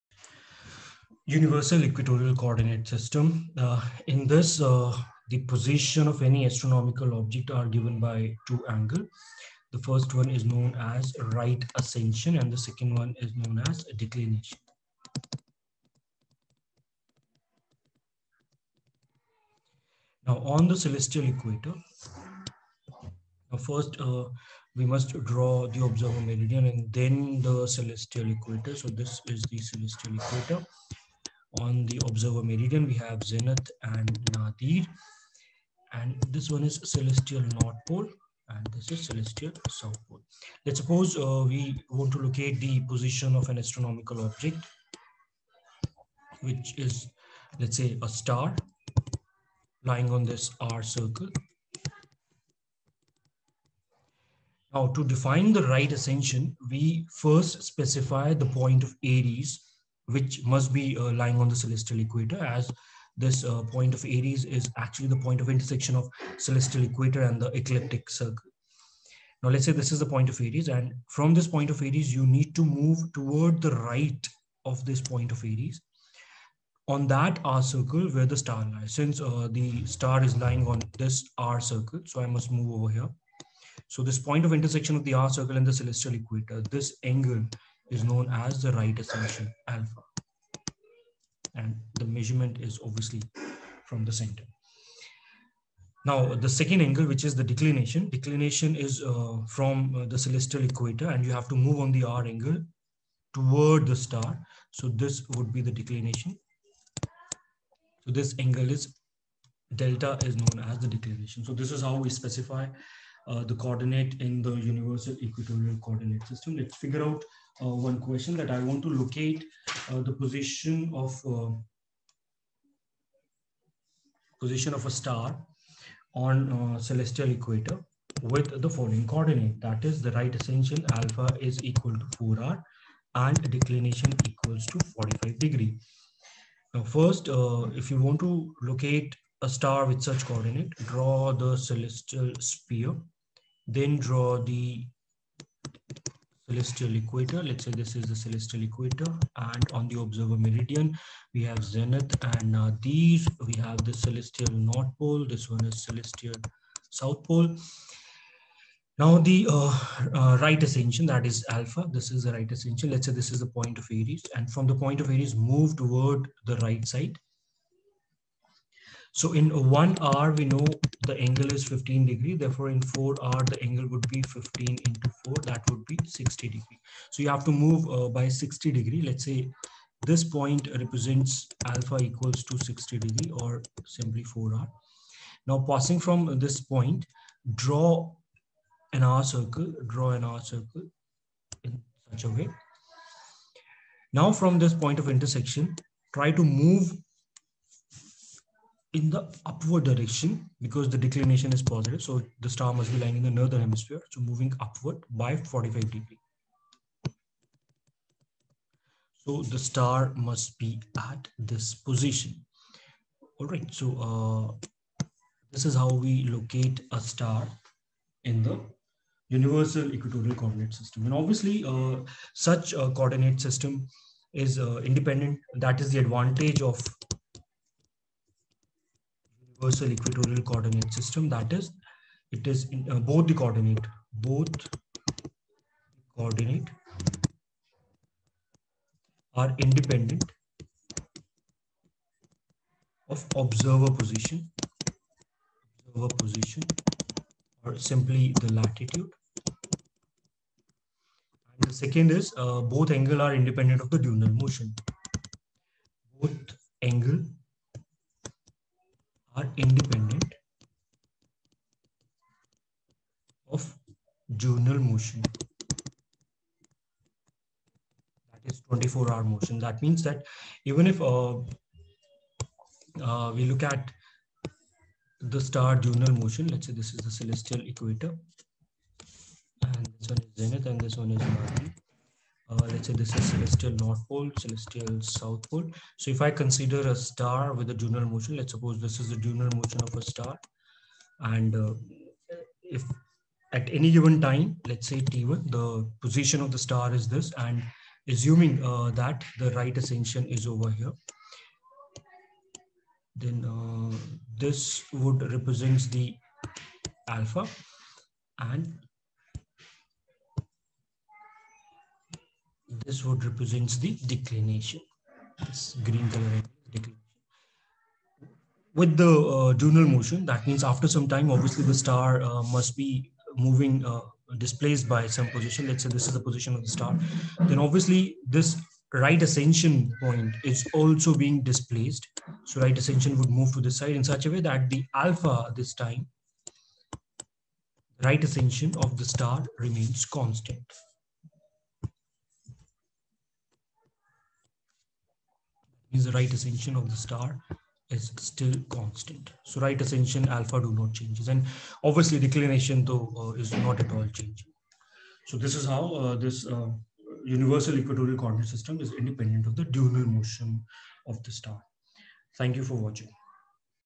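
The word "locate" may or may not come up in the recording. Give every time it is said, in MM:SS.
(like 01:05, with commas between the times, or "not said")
00:42, 01:58, 02:18, 03:36.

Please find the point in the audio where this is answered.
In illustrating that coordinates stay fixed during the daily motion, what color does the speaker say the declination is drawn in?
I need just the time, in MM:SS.
05:15.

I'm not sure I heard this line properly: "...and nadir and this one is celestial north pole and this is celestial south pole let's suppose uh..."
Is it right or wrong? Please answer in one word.
right.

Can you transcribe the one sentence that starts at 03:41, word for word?
And obviously uh, such a coordinate system is uh, independent.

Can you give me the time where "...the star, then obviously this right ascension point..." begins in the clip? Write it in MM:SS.
05:26.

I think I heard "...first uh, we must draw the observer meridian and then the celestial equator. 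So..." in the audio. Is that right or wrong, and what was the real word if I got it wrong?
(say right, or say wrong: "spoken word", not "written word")
right.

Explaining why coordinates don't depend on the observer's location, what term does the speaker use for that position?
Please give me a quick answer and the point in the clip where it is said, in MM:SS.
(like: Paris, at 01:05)
latitude, at 04:08.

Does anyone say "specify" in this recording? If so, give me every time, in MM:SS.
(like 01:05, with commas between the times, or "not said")
00:57, 01:52.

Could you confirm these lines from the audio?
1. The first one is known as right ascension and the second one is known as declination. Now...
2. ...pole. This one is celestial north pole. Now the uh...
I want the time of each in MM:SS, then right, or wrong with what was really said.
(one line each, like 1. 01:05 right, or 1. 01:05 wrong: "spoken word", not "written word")
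1. 00:09 right
2. 02:34 wrong: "south", not "north".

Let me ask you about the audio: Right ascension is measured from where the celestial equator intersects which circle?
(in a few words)
ecliptic circle.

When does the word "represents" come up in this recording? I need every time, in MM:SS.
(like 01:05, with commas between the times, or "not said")
03:00, 05:05, 05:13.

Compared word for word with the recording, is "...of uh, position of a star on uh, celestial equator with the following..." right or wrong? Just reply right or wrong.
right.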